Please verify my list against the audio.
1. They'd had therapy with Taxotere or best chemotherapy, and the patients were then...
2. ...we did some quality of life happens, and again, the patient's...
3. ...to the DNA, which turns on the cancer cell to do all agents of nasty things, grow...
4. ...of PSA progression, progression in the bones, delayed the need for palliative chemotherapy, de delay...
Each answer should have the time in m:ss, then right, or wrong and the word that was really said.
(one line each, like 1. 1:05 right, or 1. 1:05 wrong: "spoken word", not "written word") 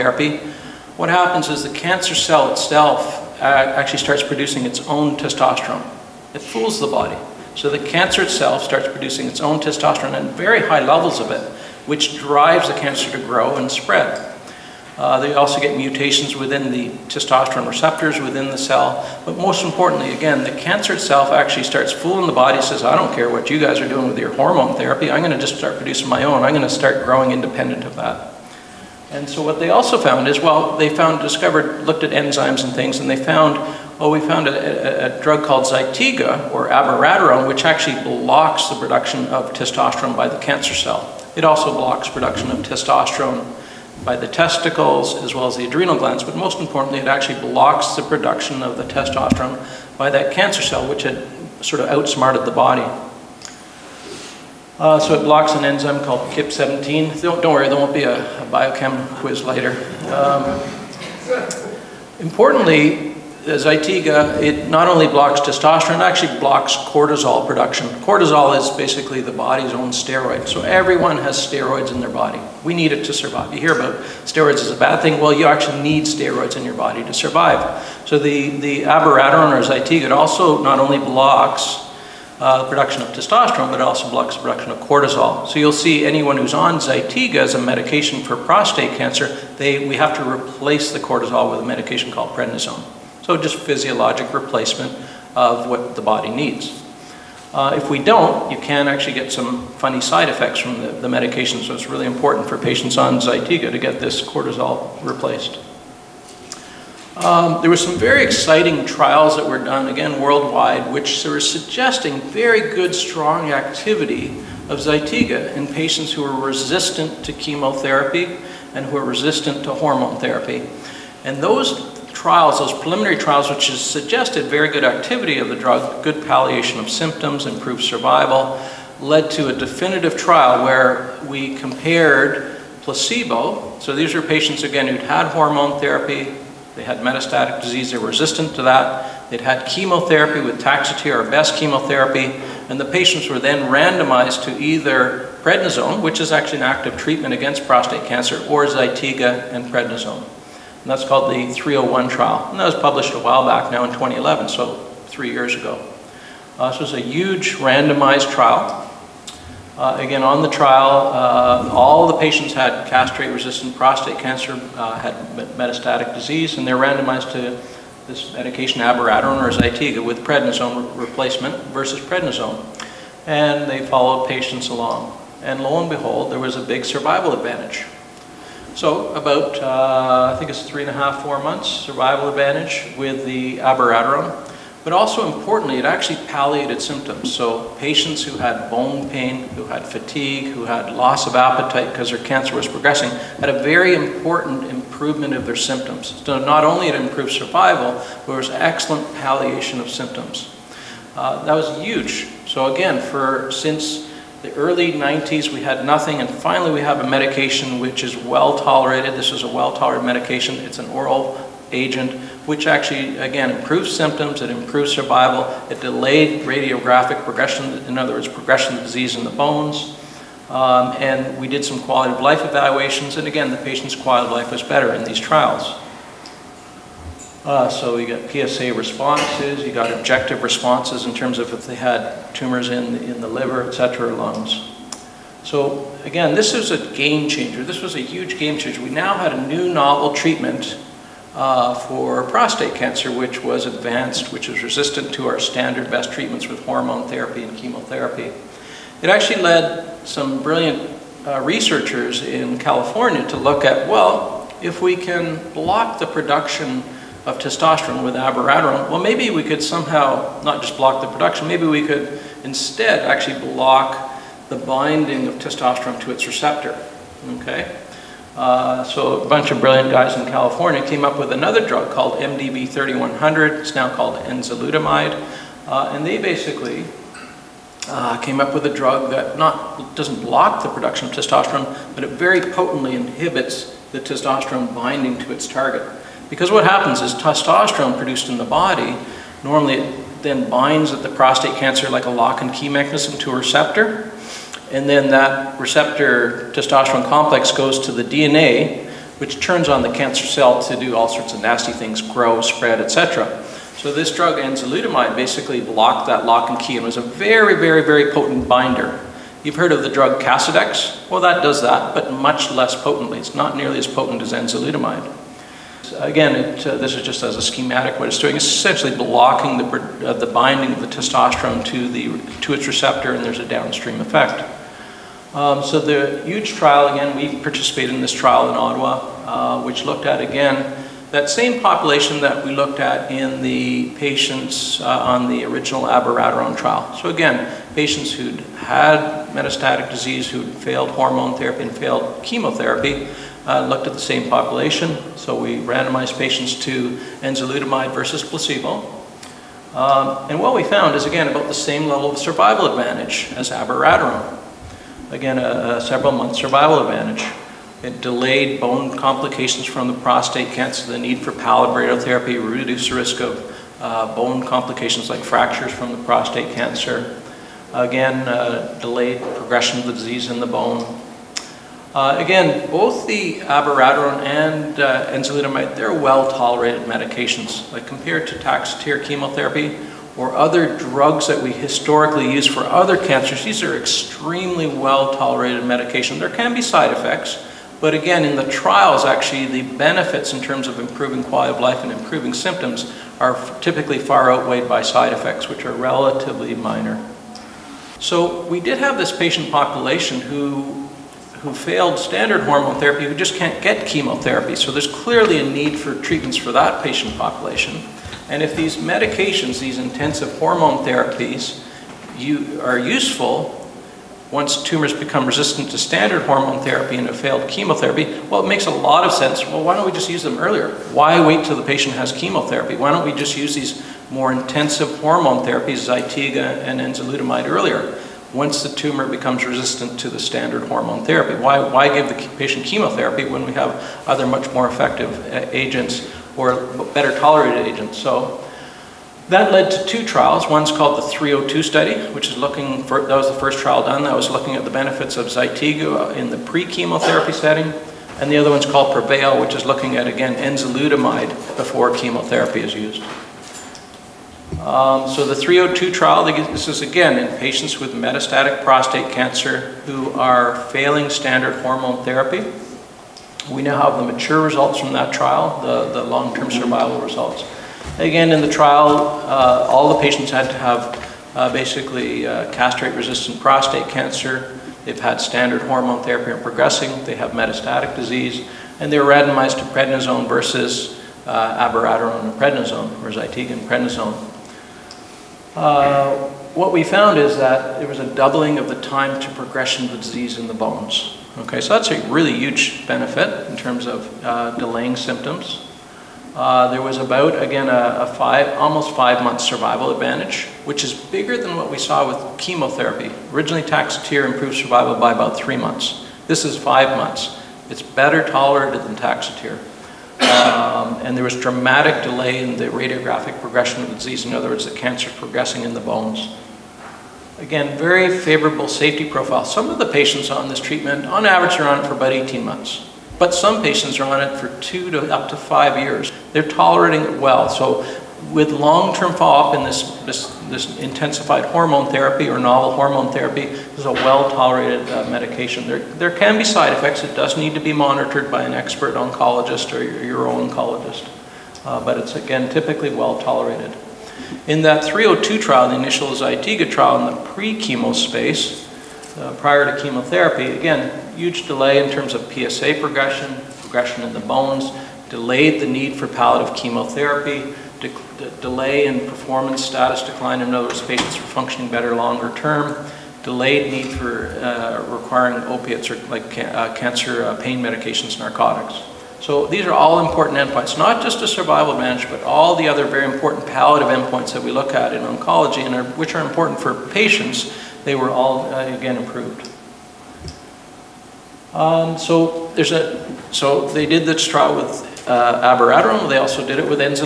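1. 2:19 wrong: "chemotherapy", not "therapy"
2. 3:41 wrong: "evaluations", not "happens"
3. 4:57 wrong: "sorts", not "agents"
4. 9:12 right.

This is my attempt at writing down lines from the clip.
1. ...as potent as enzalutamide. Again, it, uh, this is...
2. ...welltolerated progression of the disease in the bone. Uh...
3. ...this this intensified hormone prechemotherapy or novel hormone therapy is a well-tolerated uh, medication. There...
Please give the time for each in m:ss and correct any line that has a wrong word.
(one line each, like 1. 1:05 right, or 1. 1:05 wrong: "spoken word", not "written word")
1. 5:13 right
2. 6:08 wrong: "delayed", not "welltolerated"
3. 8:50 wrong: "therapy", not "prechemotherapy".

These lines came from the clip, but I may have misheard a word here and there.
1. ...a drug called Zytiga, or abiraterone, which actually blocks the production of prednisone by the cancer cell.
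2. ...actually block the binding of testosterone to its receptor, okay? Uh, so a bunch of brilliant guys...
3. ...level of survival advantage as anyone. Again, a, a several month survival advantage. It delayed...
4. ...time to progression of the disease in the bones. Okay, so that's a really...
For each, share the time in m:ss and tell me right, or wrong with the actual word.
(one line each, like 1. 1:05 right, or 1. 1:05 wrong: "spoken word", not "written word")
1. 0:35 wrong: "testosterone", not "prednisone"
2. 4:22 right
3. 5:51 wrong: "abiraterone", not "anyone"
4. 8:08 right.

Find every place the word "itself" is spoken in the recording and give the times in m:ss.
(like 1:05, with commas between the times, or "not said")
0:02, 0:08, 0:20.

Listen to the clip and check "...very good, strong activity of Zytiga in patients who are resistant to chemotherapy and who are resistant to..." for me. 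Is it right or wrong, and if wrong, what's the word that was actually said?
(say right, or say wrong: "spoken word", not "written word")
right.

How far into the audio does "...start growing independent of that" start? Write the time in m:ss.
0:26.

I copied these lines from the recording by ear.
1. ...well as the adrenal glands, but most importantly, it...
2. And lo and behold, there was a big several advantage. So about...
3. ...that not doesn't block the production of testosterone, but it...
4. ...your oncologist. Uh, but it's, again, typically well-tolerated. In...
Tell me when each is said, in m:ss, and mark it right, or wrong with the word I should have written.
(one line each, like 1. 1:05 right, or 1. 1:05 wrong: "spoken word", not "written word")
1. 0:45 right
2. 2:55 wrong: "survival", not "several"
3. 4:39 right
4. 9:00 right.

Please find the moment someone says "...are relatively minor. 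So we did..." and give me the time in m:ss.
6:35.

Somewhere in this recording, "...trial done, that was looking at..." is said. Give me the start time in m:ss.
7:23.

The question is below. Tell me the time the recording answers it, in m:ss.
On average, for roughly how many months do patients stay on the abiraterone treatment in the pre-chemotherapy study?
8:42.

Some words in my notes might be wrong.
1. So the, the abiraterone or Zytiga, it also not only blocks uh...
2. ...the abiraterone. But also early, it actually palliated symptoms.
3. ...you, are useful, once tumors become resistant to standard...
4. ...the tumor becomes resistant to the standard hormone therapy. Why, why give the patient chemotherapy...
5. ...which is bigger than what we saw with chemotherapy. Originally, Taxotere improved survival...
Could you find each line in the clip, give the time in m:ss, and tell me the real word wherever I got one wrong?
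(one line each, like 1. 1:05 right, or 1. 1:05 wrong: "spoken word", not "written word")
1. 1:18 right
2. 3:03 wrong: "importantly", not "early"
3. 6:52 right
4. 7:08 right
5. 8:20 right.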